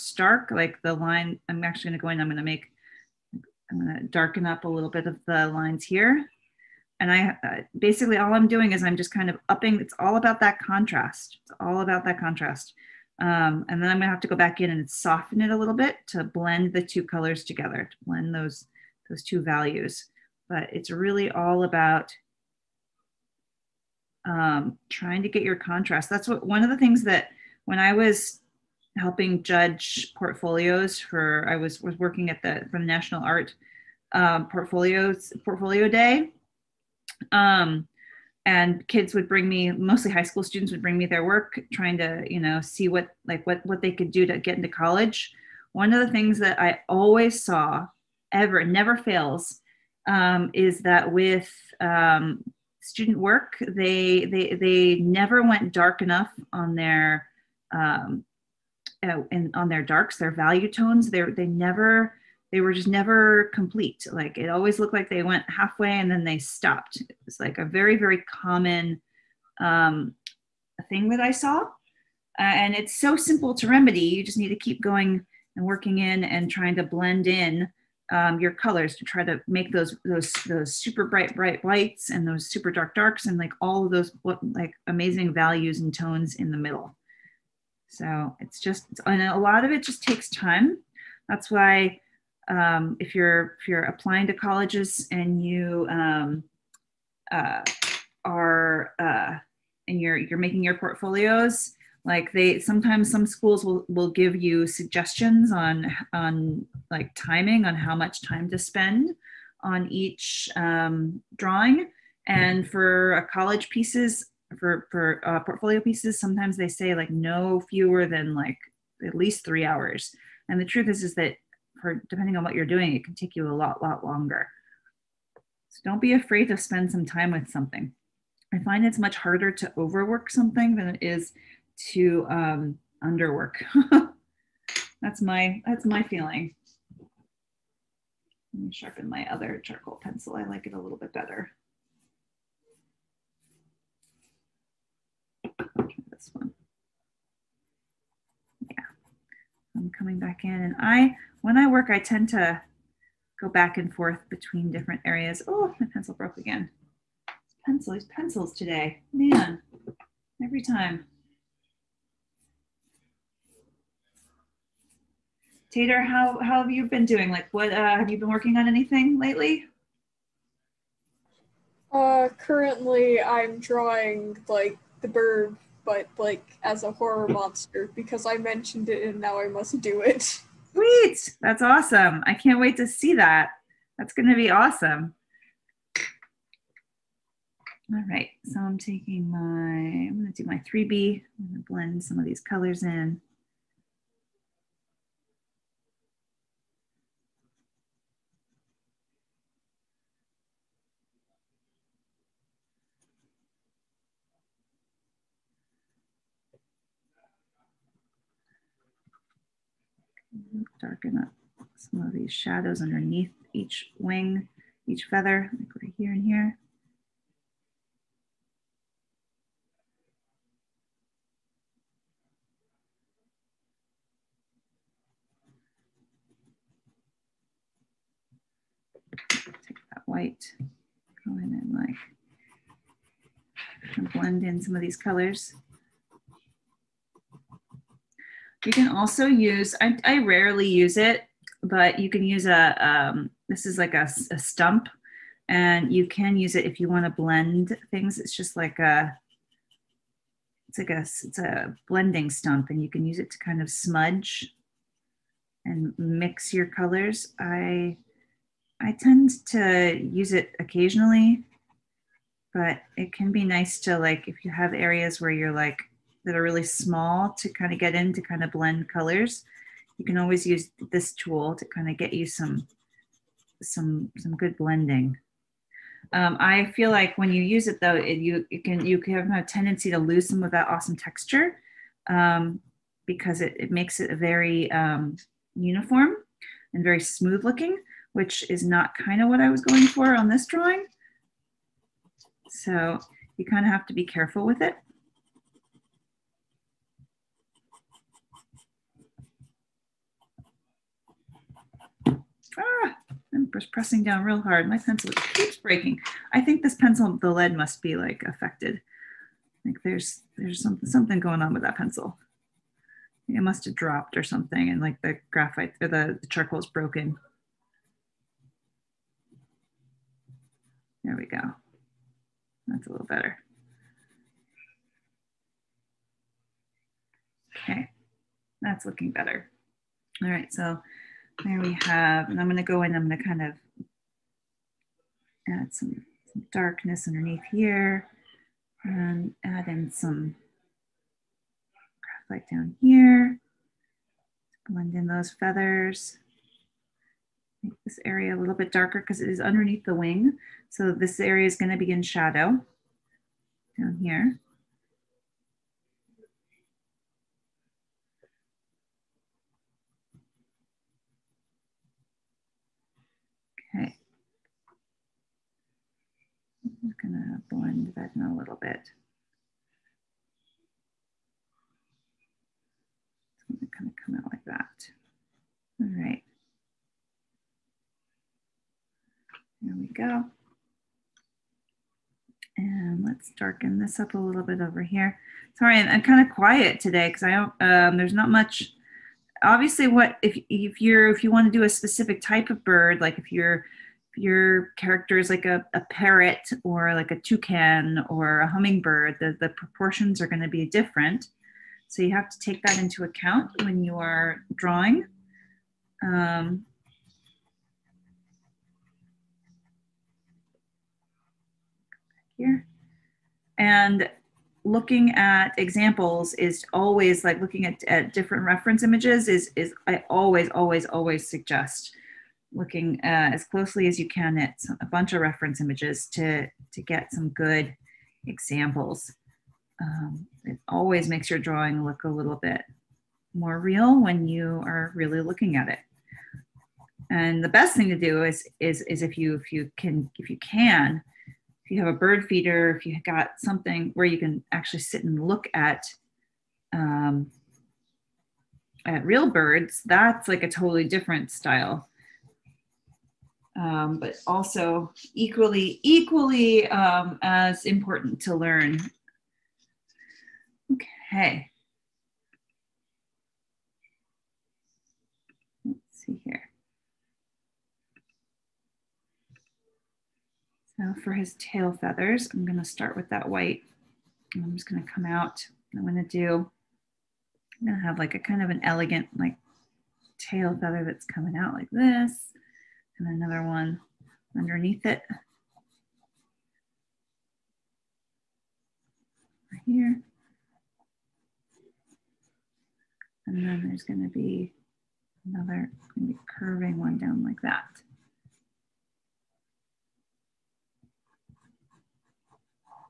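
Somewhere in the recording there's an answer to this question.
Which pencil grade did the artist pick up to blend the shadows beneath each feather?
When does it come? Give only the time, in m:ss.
3:10.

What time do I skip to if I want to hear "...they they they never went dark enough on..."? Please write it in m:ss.
0:53.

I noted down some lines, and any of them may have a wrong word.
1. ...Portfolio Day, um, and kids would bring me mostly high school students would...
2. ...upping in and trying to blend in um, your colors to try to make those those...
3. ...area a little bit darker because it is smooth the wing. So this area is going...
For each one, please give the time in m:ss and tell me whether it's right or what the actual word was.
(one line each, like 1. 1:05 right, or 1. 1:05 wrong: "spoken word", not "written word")
1. 0:35 right
2. 1:15 wrong: "working", not "upping"
3. 5:48 wrong: "underneath", not "smooth".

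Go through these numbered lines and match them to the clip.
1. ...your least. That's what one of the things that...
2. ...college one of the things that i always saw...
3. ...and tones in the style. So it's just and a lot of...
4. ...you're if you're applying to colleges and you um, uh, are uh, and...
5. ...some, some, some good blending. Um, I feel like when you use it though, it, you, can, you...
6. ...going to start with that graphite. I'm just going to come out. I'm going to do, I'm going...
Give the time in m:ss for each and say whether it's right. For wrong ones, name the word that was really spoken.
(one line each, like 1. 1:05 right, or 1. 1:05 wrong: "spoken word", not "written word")
1. 0:25 wrong: "contrast", not "least"
2. 0:44 right
3. 1:25 wrong: "middle", not "style"
4. 1:33 right
5. 4:32 right
6. 7:52 wrong: "white", not "graphite".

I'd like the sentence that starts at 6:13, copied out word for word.
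It's gonna kind of come out like that.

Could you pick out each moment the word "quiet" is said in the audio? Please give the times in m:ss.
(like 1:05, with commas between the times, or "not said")
6:26.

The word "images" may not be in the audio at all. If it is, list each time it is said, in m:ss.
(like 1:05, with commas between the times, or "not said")
6:58, 7:05.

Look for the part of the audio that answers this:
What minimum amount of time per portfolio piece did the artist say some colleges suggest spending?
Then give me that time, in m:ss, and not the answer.
1:59.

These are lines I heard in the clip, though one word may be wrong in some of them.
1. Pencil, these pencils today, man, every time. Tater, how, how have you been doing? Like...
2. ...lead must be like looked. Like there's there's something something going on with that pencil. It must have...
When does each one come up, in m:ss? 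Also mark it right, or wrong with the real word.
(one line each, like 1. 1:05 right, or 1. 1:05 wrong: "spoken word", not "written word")
1. 2:37 right
2. 5:07 wrong: "affected", not "looked".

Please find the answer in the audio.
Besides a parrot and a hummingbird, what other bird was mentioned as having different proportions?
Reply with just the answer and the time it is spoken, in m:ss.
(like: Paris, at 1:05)
toucan, at 6:37.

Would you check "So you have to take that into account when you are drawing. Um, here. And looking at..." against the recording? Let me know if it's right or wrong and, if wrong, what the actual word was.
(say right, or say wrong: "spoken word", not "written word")
right.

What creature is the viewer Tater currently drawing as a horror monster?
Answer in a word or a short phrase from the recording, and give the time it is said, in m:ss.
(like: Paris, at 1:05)
the bird, at 2:55.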